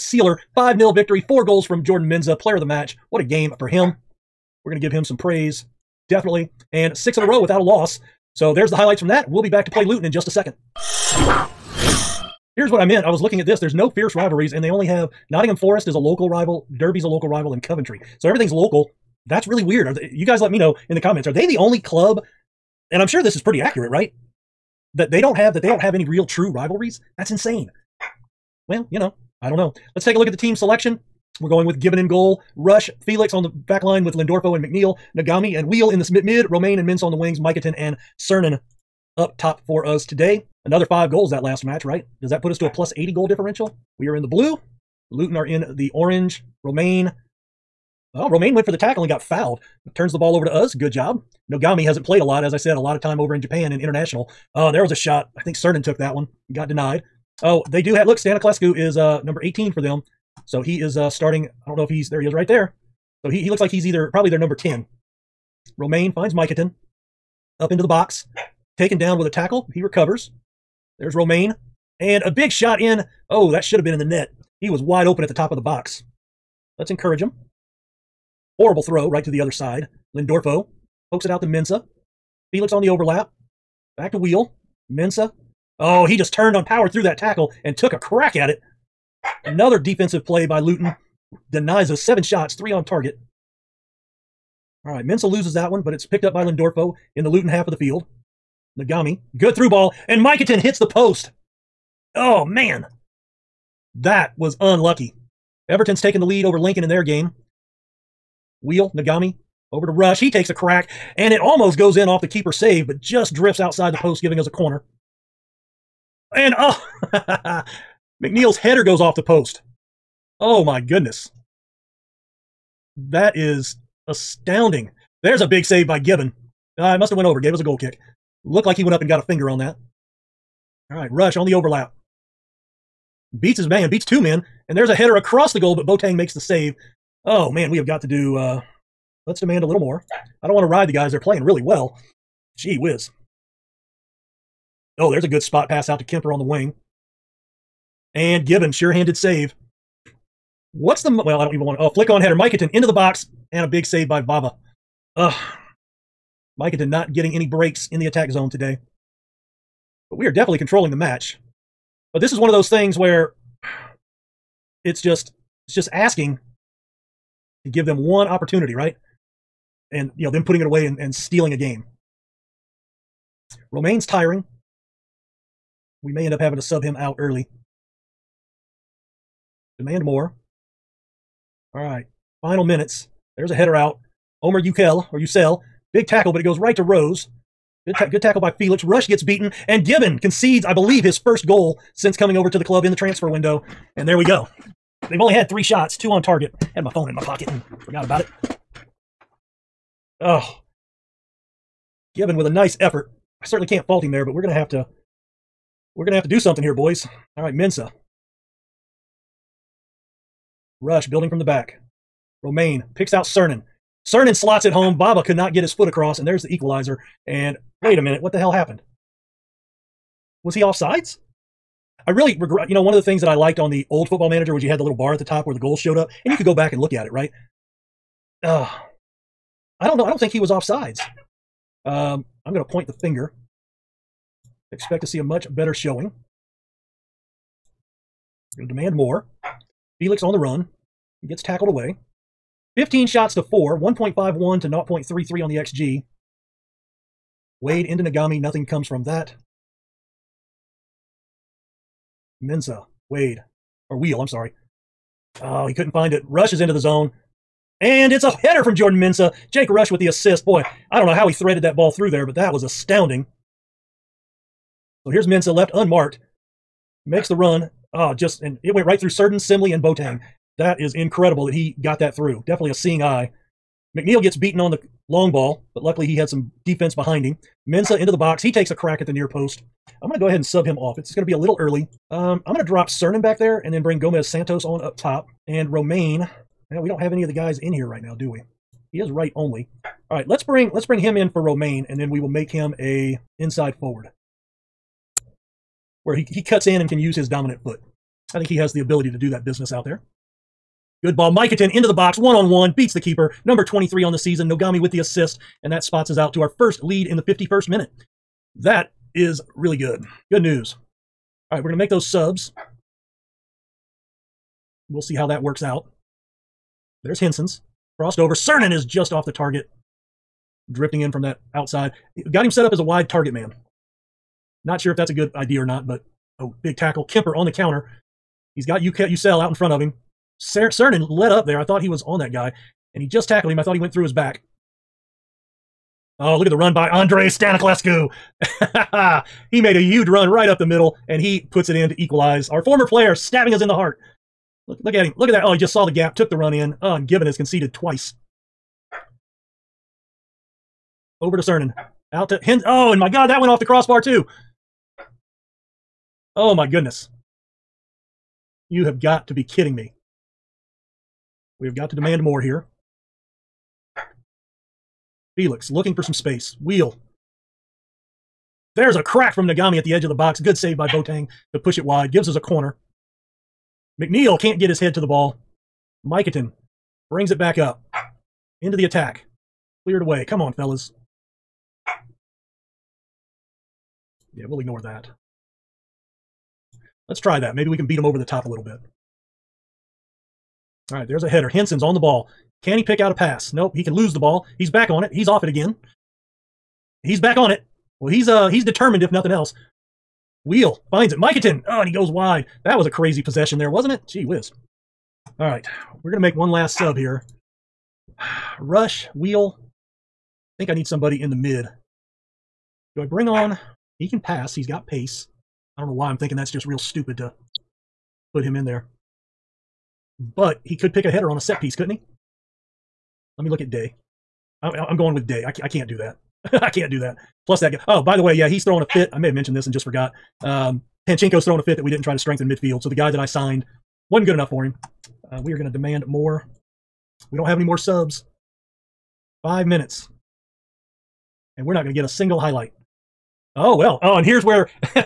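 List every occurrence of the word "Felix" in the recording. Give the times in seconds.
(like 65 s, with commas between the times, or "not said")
33 s, 82 s, 188 s, 240 s, 365 s.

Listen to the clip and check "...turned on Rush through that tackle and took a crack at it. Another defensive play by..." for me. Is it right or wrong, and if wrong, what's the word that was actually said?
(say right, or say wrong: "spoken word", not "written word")
wrong: "Power", not "Rush".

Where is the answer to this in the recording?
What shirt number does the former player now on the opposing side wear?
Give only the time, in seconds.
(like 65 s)
59 s.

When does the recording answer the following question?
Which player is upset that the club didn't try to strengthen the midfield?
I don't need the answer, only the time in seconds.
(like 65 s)
431 s.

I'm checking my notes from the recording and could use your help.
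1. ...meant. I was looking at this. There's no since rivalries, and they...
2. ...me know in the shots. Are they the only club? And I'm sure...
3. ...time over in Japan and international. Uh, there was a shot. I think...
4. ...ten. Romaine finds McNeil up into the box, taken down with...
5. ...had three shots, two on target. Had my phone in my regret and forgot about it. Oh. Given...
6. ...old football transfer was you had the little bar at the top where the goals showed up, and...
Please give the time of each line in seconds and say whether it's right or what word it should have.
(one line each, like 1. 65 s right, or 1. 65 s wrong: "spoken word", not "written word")
1. 12 s wrong: "fierce", not "since"
2. 20 s wrong: "comments", not "shots"
3. 53 s right
4. 64 s wrong: "Miketon", not "McNeil"
5. 195 s wrong: "pocket", not "regret"
6. 223 s wrong: "manager", not "transfer".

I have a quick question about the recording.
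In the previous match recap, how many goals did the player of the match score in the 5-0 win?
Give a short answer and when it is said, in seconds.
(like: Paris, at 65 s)
4, at 1 s.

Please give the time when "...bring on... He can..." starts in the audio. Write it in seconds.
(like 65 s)
413 s.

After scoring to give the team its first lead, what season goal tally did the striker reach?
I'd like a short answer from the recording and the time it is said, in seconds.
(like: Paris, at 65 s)
23, at 303 s.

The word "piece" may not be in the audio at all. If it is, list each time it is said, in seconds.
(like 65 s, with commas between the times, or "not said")
421 s.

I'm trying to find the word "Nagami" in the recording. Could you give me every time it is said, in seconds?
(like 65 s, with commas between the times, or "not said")
35 s, 98 s, 108 s, 248 s, 369 s.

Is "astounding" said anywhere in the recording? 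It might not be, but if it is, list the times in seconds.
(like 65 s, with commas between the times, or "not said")
124 s, 262 s.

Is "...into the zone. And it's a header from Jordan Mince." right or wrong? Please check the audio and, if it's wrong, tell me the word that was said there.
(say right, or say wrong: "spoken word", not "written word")
wrong: "Mensa", not "Mince".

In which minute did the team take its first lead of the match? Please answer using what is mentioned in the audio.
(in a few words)
51st.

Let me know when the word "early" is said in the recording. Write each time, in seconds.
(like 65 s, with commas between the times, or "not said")
177 s, 281 s.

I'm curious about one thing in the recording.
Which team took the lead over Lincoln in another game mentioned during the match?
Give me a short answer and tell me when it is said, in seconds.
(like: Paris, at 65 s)
Everton, at 105 s.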